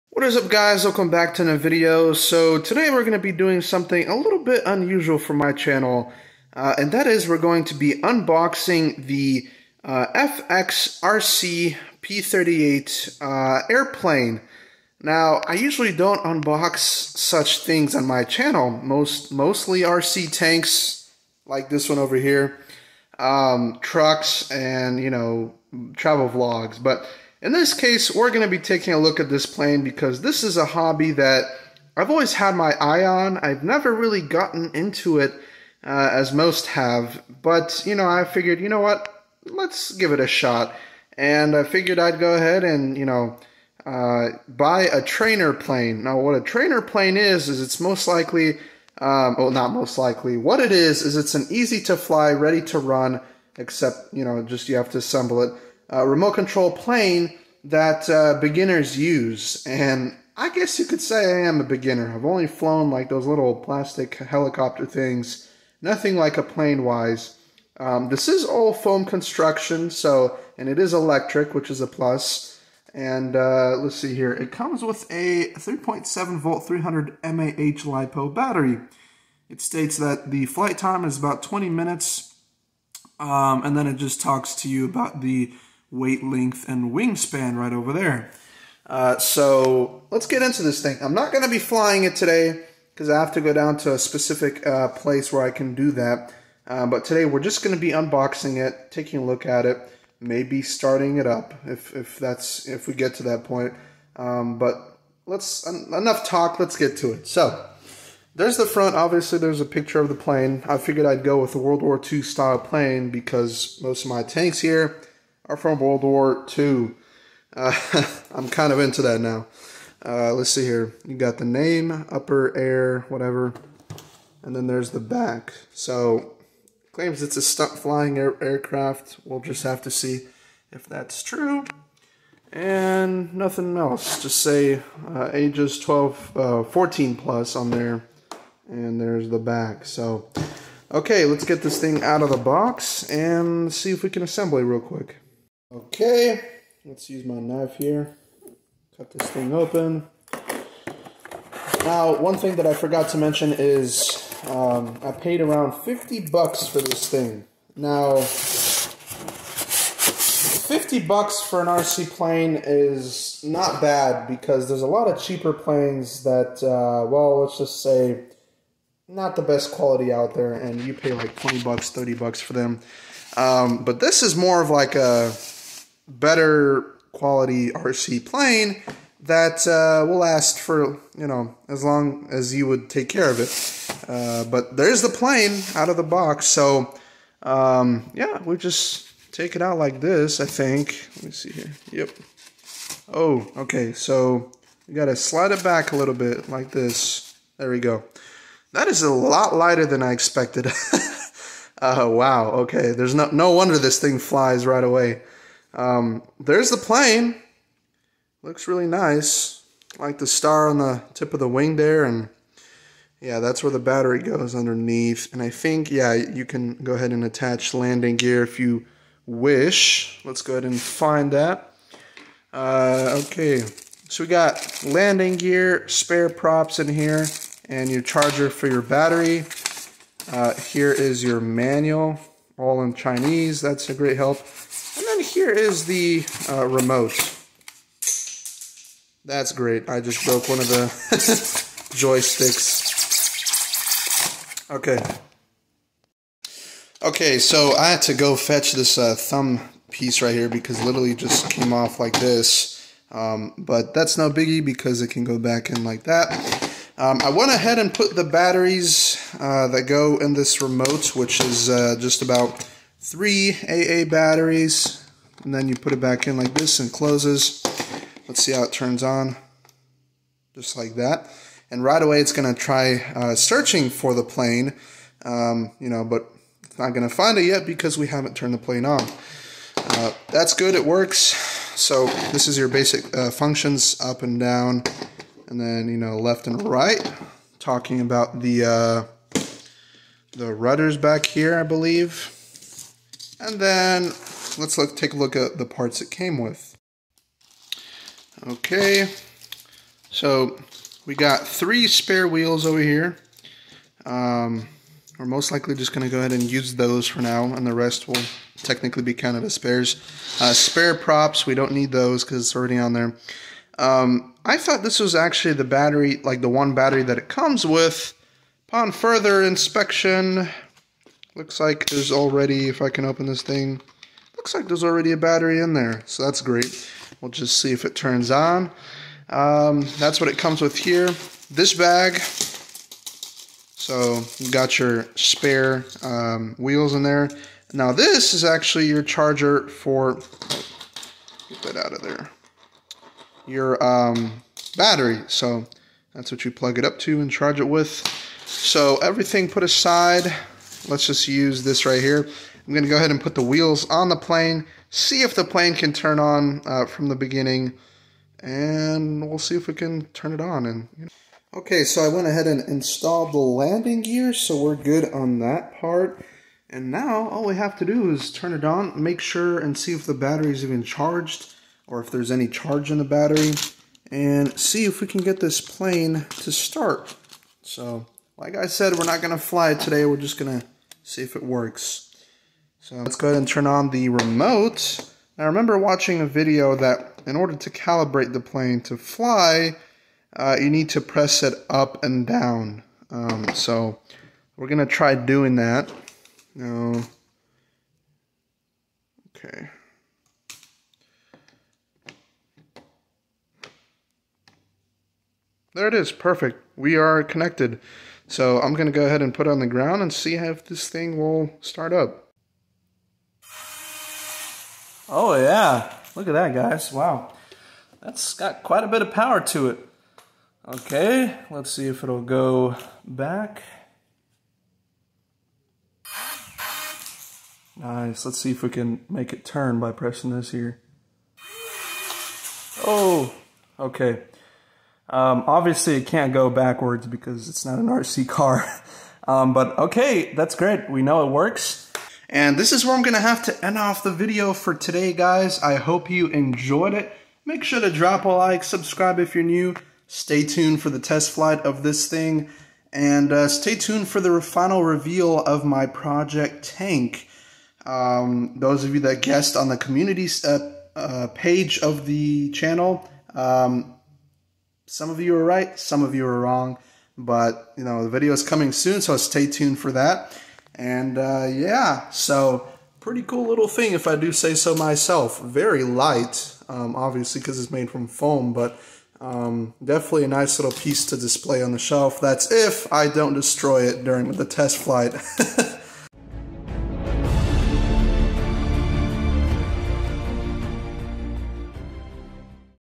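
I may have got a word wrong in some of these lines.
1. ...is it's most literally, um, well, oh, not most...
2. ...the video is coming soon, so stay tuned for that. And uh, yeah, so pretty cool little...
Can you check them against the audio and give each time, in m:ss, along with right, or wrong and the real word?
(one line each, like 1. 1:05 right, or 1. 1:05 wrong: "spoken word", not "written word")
1. 0:47 wrong: "likely", not "literally"
2. 7:48 right.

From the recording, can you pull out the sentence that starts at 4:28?
Let's see how it turns on, just like that.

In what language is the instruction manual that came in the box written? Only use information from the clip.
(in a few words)
Chinese.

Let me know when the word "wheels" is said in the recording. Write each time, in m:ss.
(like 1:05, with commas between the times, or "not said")
5:02, 5:36, 5:53.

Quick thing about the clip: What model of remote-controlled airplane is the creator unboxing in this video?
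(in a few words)
FXRC P38.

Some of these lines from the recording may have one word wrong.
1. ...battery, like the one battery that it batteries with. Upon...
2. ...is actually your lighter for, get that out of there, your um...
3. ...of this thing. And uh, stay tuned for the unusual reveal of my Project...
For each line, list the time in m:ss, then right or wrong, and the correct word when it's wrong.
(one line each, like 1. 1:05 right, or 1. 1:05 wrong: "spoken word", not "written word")
1. 5:15 wrong: "comes", not "batteries"
2. 5:38 wrong: "charger", not "lighter"
3. 7:31 wrong: "final", not "unusual".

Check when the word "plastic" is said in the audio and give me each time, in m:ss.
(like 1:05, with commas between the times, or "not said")
1:03.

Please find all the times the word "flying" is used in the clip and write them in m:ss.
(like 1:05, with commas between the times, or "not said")
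1:31, 2:07.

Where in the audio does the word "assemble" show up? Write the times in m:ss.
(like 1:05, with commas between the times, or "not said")
0:54, 2:24.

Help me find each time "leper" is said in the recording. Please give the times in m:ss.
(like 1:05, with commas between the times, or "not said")
not said.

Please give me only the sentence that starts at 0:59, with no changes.
And I guess you could say I am a beginner.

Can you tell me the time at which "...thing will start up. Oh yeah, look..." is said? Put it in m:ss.
6:50.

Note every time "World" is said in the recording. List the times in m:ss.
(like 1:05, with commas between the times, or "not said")
1:51, 1:55.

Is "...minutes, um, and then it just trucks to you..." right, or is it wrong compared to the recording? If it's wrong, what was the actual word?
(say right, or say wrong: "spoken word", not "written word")
wrong: "talks", not "trucks".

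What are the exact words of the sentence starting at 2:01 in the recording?
You got the name, upper air, whatever.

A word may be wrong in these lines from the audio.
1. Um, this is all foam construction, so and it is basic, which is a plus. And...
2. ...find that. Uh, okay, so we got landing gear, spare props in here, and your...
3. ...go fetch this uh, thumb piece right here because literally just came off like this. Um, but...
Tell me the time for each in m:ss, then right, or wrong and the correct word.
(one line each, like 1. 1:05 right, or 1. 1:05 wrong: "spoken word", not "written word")
1. 1:07 wrong: "electric", not "basic"
2. 3:40 right
3. 4:08 right.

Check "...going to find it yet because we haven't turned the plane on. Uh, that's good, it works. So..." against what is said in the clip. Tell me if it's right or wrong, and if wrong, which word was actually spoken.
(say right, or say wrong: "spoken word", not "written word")
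right.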